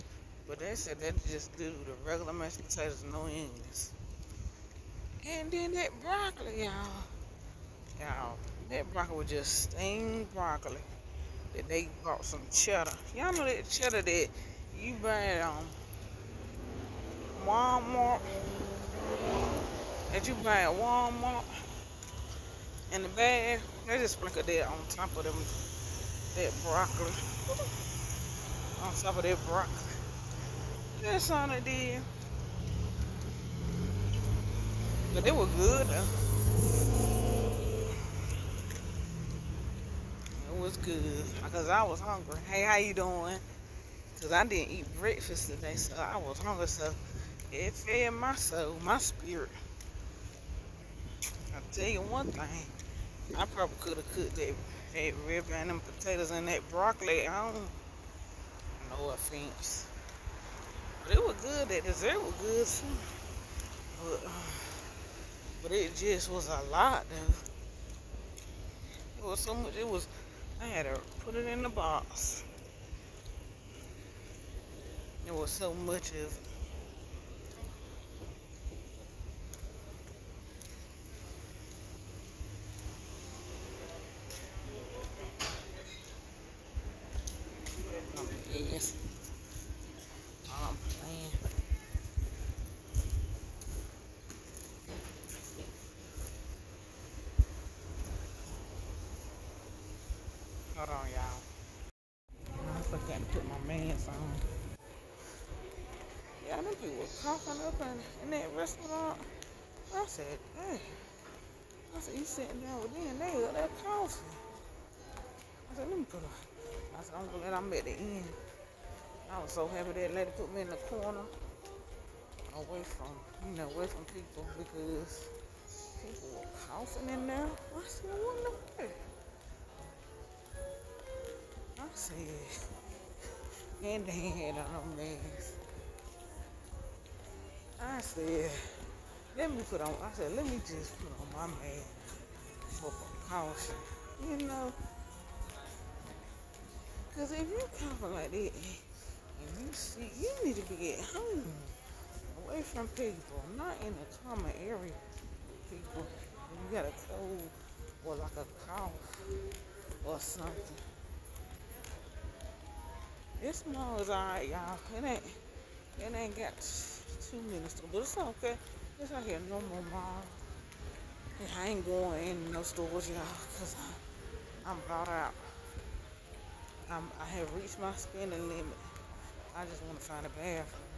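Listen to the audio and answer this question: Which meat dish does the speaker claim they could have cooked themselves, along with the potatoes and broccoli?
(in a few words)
Rib.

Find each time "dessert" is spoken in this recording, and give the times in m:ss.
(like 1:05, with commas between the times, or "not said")
1:01.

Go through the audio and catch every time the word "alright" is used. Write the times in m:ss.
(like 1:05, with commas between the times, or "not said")
2:44.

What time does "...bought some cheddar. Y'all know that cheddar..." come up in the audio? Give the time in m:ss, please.
0:12.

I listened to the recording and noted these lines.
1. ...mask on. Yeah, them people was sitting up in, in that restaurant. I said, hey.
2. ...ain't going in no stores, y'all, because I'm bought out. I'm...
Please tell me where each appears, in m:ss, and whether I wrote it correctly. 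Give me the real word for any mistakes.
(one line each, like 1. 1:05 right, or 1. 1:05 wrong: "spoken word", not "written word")
1. 1:43 wrong: "coughing", not "sitting"
2. 2:51 right.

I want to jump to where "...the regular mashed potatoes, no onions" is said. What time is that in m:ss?
0:01.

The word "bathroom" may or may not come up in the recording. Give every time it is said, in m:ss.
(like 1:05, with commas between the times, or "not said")
3:00.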